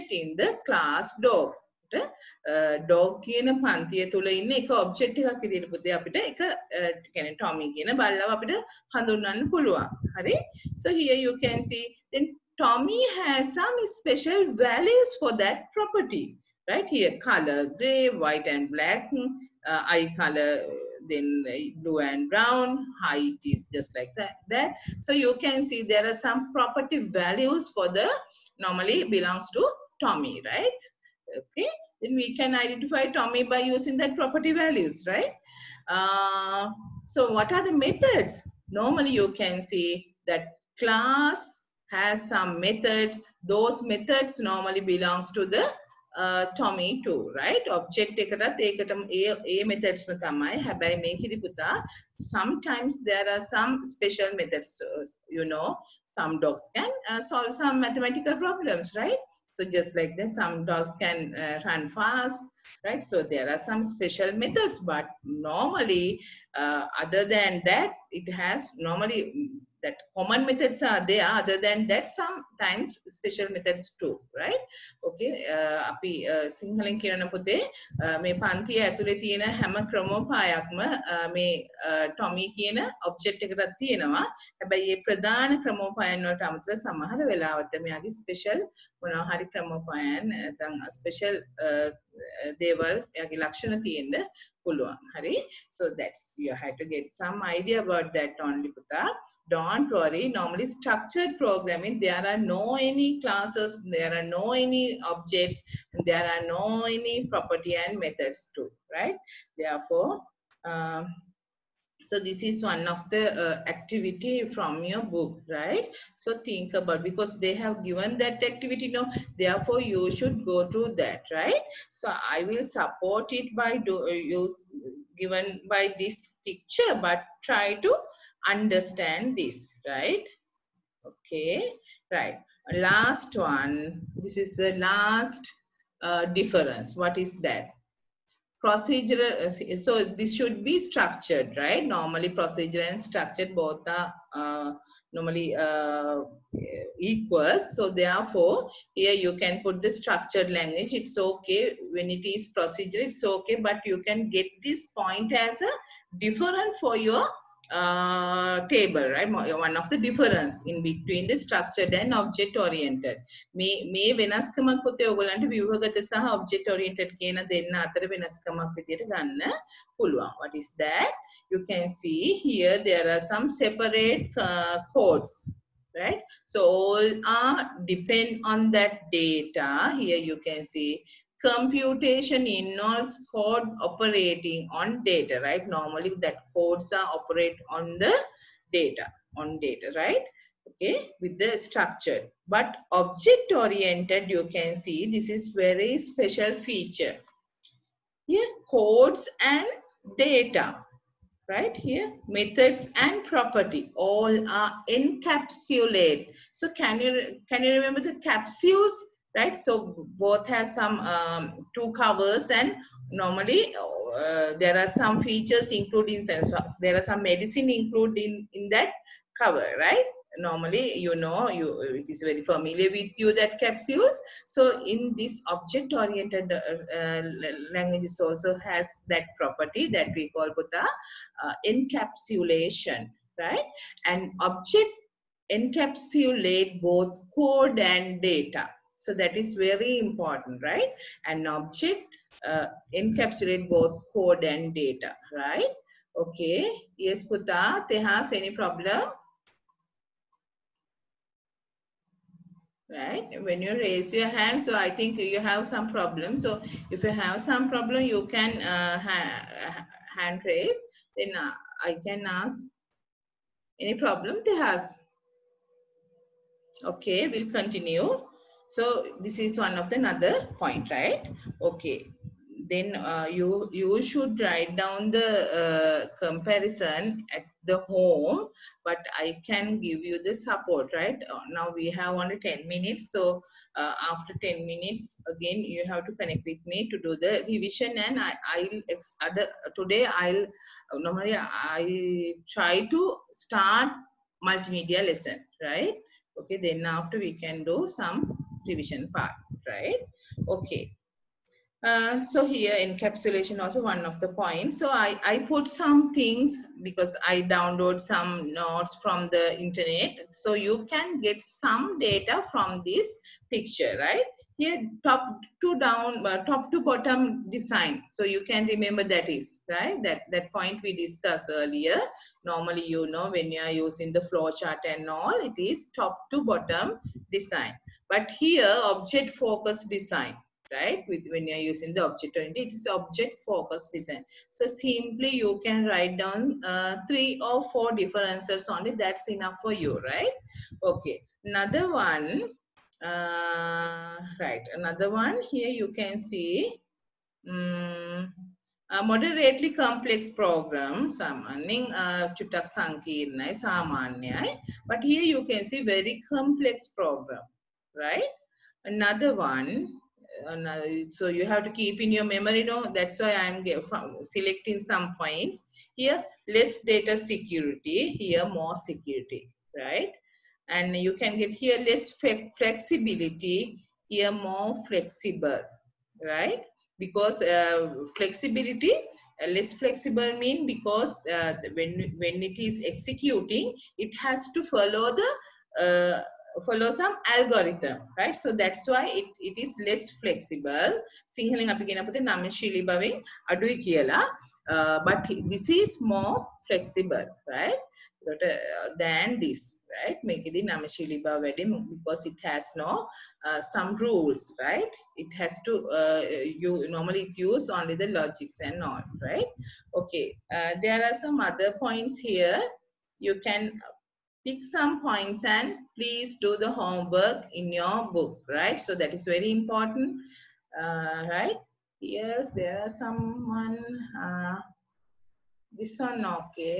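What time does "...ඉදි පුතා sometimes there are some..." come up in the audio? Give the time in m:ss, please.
0:51.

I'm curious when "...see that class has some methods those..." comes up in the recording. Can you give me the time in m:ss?
0:39.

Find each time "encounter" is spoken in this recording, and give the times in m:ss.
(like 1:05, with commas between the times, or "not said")
not said.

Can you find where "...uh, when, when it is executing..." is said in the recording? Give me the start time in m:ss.
6:21.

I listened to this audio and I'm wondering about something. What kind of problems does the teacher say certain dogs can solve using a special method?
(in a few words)
Mathematical problems.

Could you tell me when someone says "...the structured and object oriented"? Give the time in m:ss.
2:41.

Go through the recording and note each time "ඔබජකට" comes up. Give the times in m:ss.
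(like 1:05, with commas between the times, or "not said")
1:23.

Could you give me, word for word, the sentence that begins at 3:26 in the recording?
So can you, can you remember the capsules?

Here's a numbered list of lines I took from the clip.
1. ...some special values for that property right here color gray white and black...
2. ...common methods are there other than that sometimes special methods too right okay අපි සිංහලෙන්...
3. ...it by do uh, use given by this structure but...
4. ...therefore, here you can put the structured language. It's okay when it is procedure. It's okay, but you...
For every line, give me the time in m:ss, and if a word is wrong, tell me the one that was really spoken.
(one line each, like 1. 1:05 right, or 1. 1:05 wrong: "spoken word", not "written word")
1. 0:13 right
2. 1:10 right
3. 2:03 wrong: "picture", not "structure"
4. 2:27 right.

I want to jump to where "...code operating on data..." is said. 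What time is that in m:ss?
3:03.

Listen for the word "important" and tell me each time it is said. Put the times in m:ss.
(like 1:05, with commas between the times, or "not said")
3:59, 6:59.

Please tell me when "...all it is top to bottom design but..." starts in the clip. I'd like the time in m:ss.
5:25.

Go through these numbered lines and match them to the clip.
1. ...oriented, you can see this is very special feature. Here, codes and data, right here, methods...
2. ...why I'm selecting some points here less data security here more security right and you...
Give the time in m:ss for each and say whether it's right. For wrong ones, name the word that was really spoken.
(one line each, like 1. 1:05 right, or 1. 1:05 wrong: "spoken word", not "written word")
1. 3:13 right
2. 6:03 right.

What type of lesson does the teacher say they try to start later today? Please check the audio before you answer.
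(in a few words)
Multimedia lesson.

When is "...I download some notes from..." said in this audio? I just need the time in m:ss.
5:07.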